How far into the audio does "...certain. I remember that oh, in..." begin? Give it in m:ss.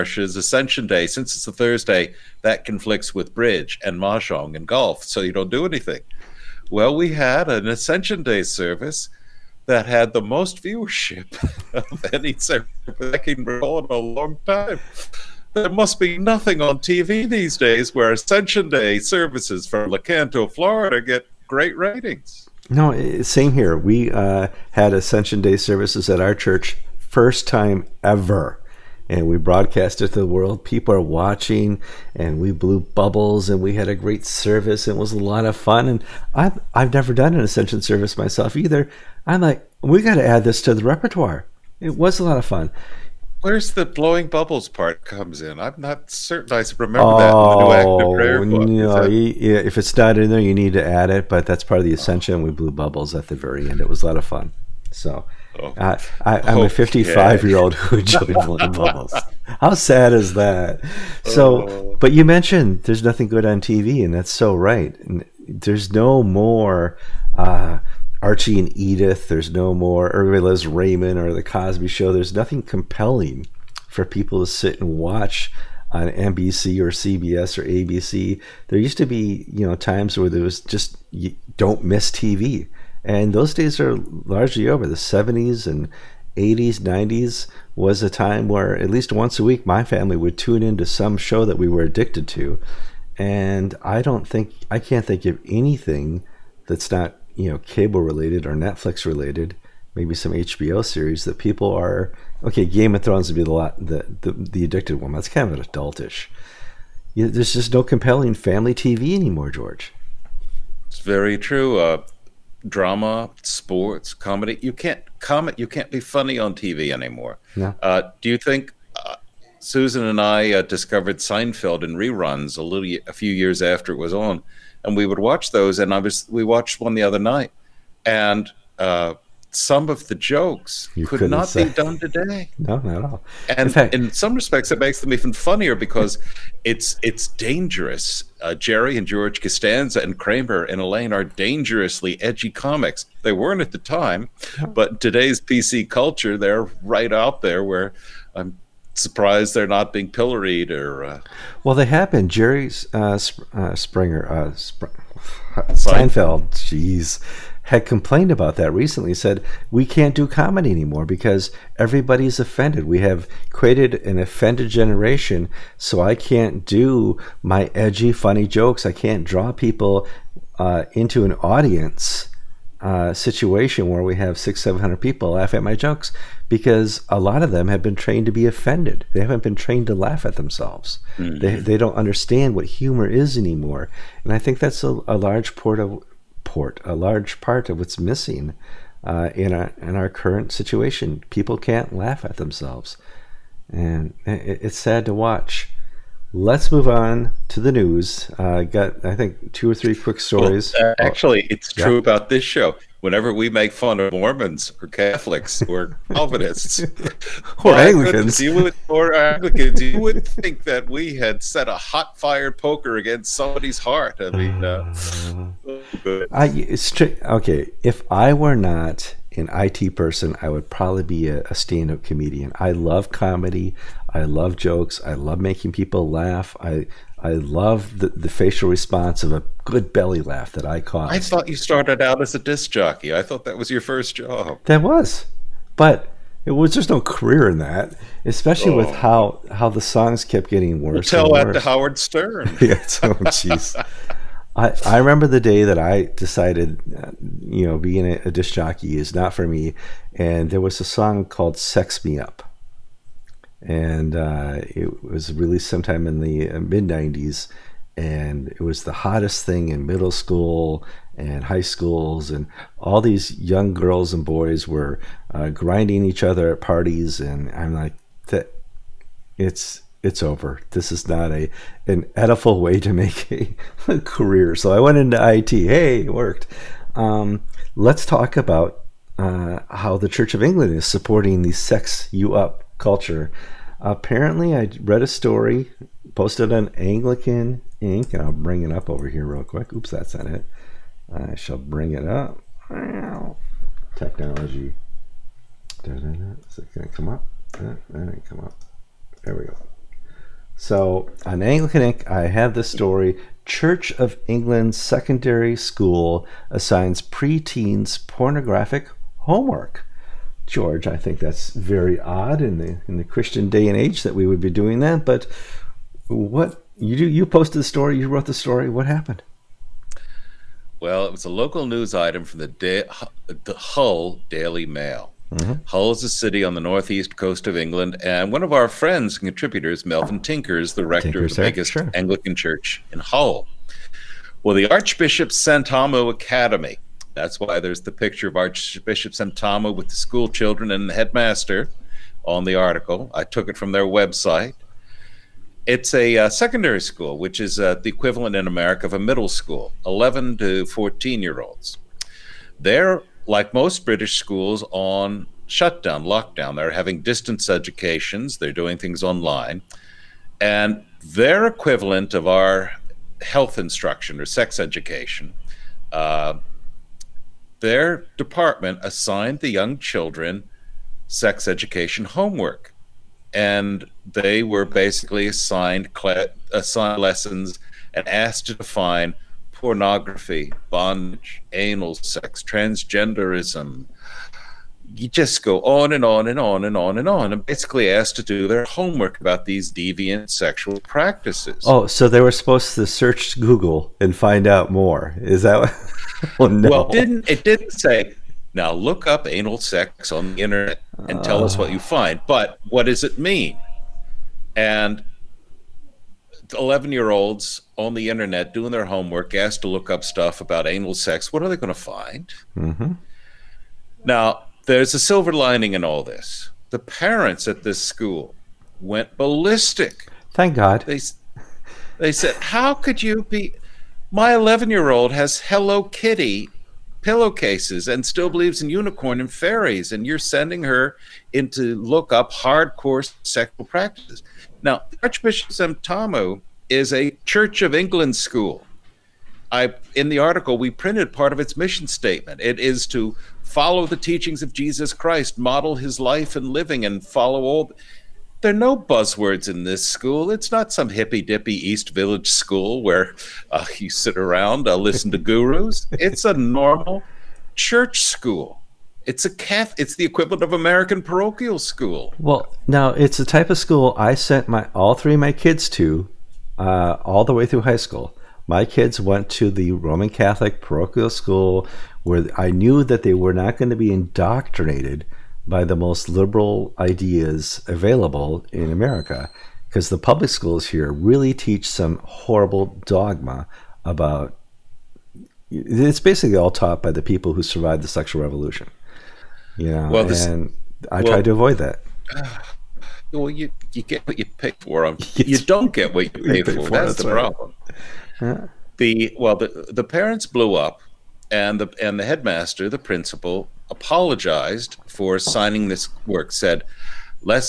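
0:46.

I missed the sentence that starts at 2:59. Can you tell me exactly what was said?
They haven't been trained to laugh at themselves.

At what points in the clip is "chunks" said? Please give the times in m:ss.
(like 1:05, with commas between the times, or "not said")
not said.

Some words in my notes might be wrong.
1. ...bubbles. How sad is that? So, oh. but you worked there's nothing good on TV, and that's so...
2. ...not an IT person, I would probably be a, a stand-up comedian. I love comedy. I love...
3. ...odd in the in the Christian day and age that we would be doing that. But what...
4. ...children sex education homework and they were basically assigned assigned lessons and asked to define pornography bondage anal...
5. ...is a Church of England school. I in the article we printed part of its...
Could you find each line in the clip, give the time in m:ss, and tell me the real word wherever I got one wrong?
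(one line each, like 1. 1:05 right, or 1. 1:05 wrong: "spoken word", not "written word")
1. 0:58 wrong: "mentioned", not "worked"
2. 3:38 right
3. 5:12 right
4. 6:09 right
5. 7:16 right.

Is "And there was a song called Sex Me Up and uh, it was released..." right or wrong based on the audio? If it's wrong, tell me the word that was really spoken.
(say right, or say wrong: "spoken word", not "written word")
right.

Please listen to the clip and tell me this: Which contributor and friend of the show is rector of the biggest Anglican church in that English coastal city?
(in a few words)
Melvin Tinker.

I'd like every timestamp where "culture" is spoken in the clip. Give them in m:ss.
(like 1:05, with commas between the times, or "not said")
2:25, 4:42.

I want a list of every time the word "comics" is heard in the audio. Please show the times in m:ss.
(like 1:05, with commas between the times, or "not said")
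2:22.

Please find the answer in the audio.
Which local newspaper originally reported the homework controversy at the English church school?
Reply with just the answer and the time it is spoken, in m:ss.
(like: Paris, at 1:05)
Hull Daily Mail, at 5:23.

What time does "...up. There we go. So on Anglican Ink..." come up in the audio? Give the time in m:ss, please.
4:58.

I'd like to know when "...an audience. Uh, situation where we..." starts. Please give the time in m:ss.
2:51.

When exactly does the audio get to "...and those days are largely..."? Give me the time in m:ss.
1:23.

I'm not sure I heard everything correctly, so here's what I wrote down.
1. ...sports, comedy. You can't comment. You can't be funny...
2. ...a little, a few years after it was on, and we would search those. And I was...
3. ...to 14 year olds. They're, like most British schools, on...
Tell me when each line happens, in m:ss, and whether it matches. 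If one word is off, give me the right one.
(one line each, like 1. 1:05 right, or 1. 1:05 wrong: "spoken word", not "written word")
1. 1:53 right
2. 2:02 wrong: "watch", not "search"
3. 5:50 right.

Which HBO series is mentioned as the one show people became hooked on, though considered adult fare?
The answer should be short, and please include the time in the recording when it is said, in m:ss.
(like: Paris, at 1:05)
Game of Thrones, at 1:42.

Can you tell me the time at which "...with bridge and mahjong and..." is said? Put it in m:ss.
0:03.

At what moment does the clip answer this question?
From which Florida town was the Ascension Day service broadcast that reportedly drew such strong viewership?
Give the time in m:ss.
0:19.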